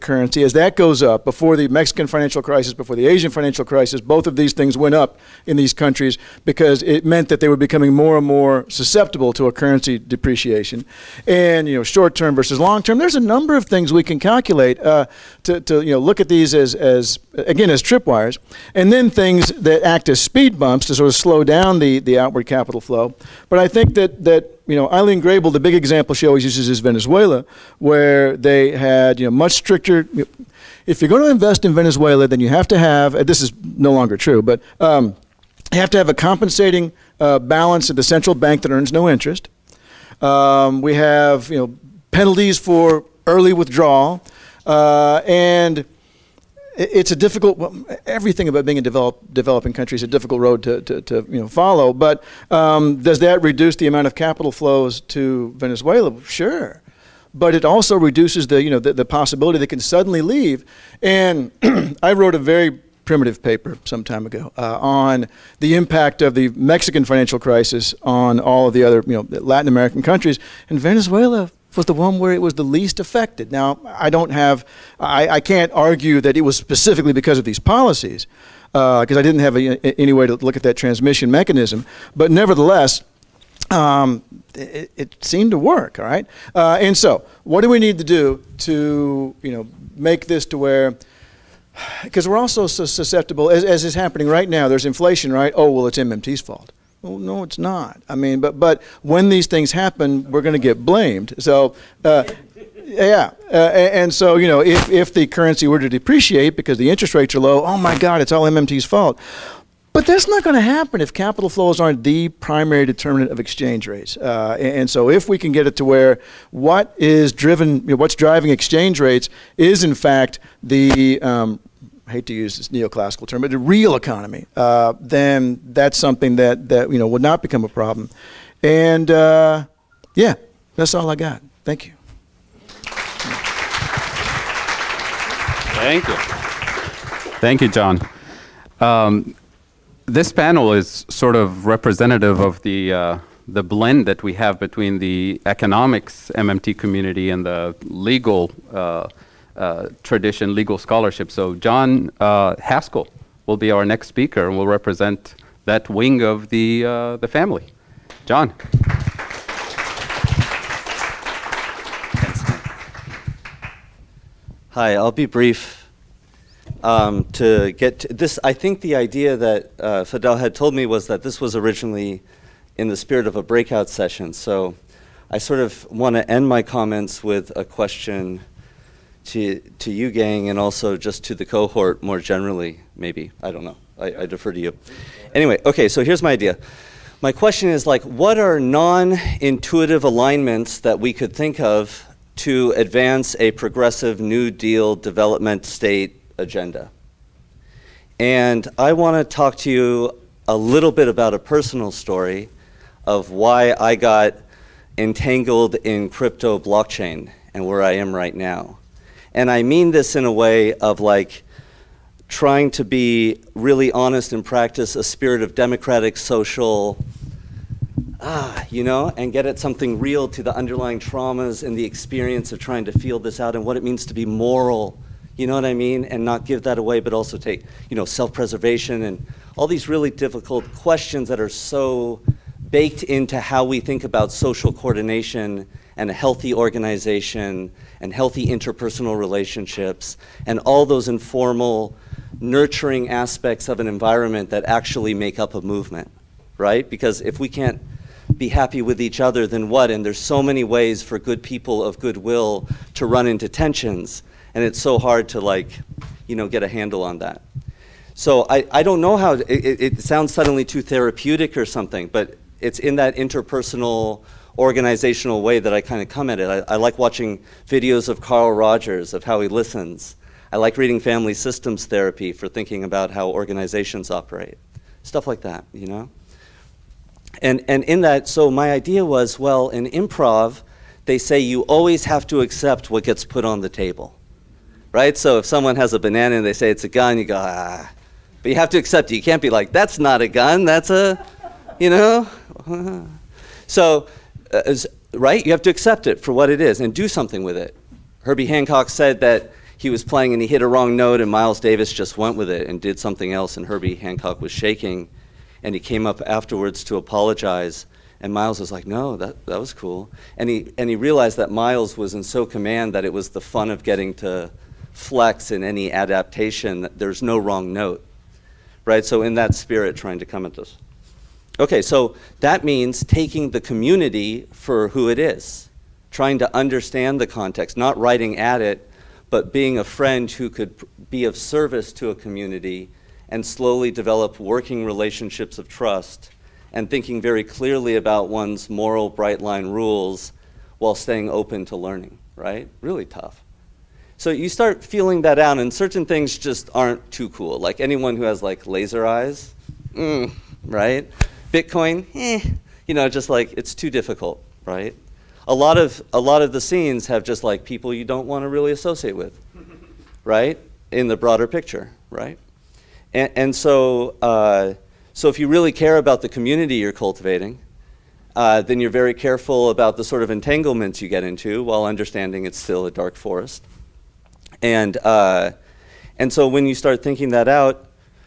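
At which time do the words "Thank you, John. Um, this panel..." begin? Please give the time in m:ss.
2:17.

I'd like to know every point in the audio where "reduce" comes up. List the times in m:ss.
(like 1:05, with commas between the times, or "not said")
0:53, 0:57.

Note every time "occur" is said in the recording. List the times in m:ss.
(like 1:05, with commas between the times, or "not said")
not said.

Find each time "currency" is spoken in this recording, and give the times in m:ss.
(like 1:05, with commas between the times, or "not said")
0:00, 0:09, 1:45.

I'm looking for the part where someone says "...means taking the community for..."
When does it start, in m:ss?
5:22.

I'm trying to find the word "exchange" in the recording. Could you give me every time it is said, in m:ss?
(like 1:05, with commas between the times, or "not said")
1:53, 1:58.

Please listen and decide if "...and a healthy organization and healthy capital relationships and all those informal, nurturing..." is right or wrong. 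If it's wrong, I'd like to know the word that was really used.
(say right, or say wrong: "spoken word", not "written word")
wrong: "interpersonal", not "capital".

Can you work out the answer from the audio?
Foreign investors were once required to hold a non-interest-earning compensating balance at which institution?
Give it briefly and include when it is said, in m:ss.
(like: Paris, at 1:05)
the central bank, at 0:38.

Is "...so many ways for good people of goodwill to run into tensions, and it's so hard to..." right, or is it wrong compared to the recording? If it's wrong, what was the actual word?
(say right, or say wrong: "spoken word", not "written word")
right.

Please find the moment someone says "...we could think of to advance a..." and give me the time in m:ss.
3:10.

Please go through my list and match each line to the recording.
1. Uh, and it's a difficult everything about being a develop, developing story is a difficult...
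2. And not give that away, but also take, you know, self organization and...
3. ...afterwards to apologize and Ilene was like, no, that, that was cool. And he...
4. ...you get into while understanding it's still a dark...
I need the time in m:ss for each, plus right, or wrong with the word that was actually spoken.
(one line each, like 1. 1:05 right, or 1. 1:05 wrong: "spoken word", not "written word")
1. 0:44 wrong: "country", not "story"
2. 3:46 wrong: "preservation", not "organization"
3. 5:06 wrong: "Miles", not "Ilene"
4. 6:11 right.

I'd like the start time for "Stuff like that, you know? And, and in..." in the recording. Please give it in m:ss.
4:35.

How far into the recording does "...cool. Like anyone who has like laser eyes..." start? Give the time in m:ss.
5:47.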